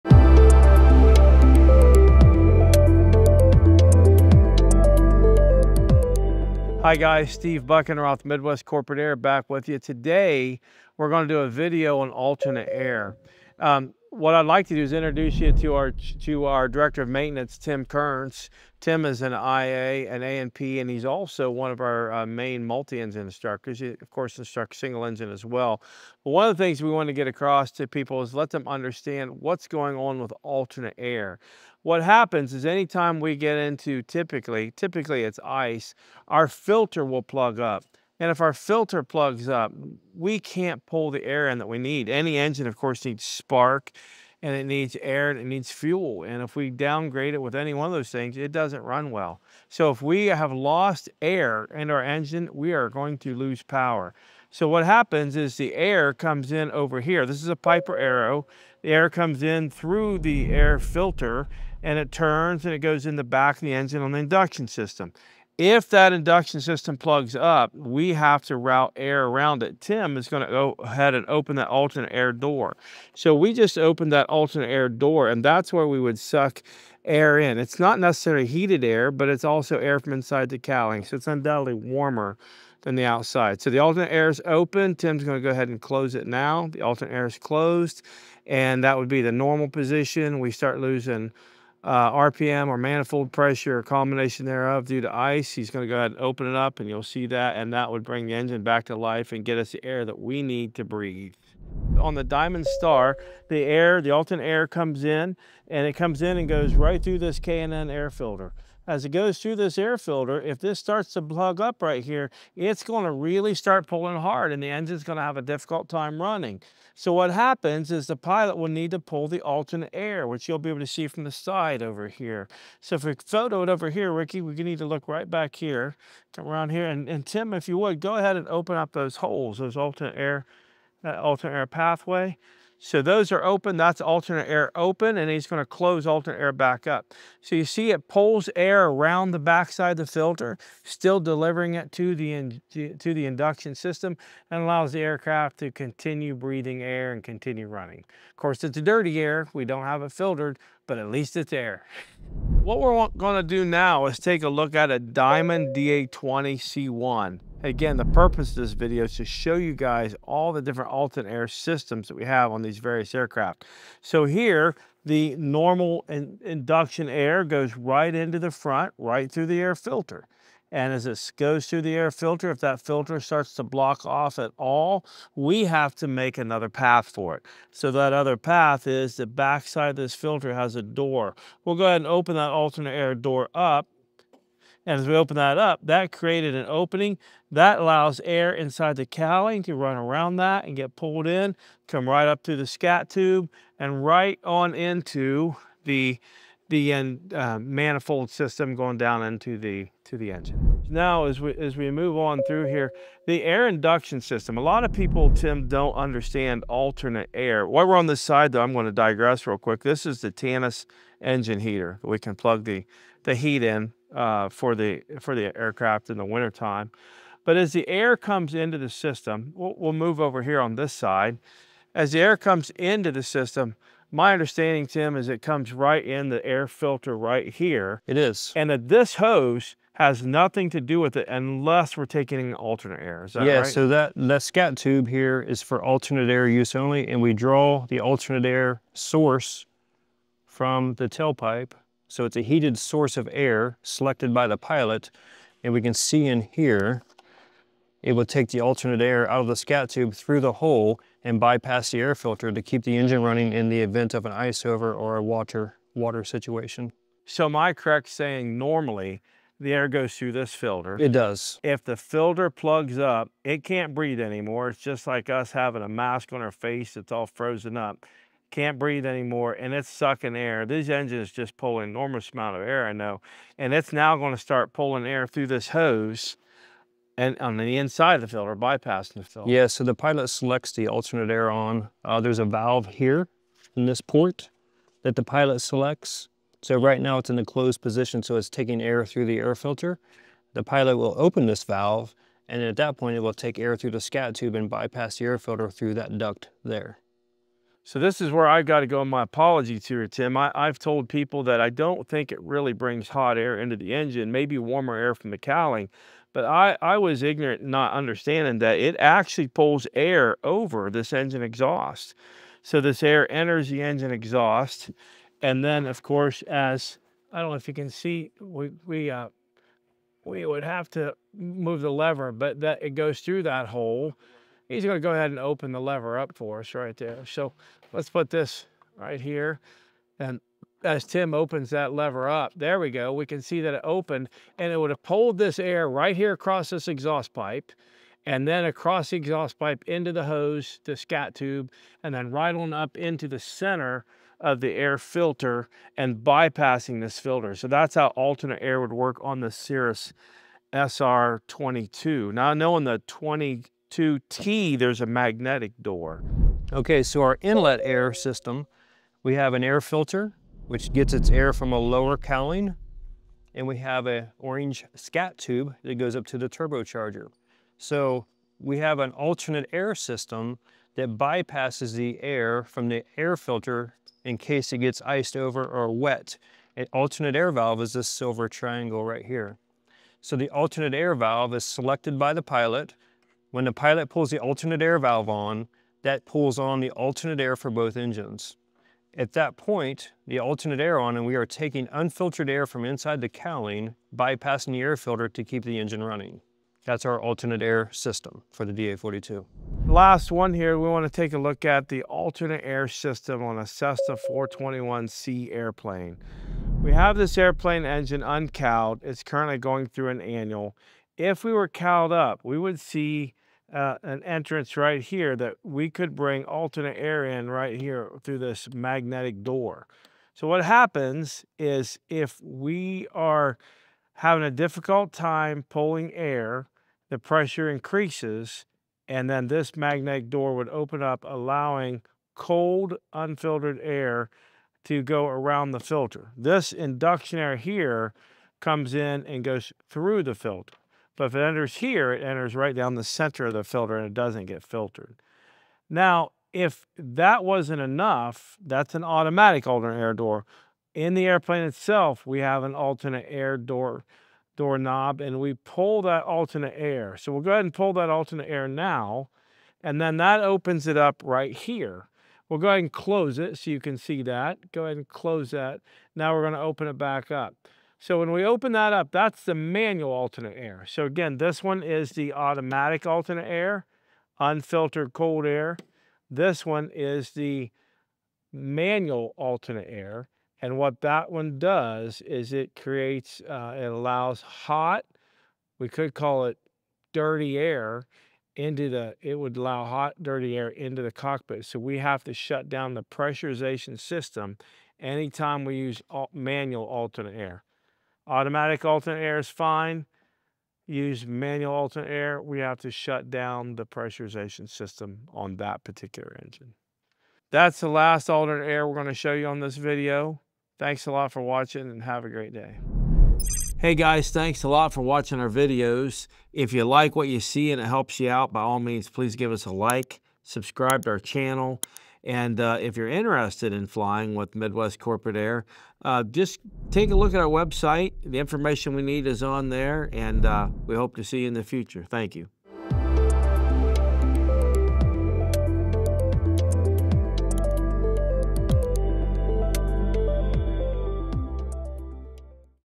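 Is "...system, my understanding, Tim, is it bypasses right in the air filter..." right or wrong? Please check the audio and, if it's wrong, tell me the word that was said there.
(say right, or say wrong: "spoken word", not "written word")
wrong: "comes", not "bypasses".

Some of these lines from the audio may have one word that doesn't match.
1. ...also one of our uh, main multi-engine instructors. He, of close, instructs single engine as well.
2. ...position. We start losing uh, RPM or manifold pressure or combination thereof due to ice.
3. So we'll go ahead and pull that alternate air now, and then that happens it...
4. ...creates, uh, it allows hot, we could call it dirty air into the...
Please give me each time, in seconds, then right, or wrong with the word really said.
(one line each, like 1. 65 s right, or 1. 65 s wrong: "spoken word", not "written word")
1. 21 s wrong: "course", not "close"
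2. 89 s right
3. 457 s wrong: "opens", not "happens"
4. 482 s right.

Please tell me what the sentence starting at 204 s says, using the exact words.
A lot of people, Tim, don't understand alternate air.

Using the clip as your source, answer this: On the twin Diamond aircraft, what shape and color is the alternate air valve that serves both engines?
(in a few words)
silver triangle.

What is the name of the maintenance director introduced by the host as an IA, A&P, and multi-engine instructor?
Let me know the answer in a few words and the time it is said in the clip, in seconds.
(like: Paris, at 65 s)
Tim Kearns, at 17 s.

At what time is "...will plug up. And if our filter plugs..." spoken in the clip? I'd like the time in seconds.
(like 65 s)
37 s.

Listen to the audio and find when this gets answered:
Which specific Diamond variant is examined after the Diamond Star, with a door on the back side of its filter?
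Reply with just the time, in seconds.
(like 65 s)
154 s.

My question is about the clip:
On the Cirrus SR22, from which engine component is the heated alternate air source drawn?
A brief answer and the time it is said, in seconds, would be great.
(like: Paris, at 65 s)
the tailpipe, at 241 s.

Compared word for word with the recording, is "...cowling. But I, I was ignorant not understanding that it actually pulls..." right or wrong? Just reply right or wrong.
right.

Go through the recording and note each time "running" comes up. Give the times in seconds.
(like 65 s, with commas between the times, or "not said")
116 s, 147 s, 253 s, 396 s.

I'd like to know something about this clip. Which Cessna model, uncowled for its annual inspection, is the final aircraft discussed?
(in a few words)
Cessna 421C.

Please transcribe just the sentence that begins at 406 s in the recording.
We have this airplane engine uncowled.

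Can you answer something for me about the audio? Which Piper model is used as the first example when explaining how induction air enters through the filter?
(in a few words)
Piper Arrow.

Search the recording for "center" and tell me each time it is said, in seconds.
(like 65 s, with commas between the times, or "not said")
343 s, 443 s.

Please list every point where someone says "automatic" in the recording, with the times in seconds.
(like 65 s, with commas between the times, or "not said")
449 s, 472 s, 498 s.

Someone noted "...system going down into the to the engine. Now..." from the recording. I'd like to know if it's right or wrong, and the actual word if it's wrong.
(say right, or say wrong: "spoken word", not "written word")
right.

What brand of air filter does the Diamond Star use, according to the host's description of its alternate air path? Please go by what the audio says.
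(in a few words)
K&N.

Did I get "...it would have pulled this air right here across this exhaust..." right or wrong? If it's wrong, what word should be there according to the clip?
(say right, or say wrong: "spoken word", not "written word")
right.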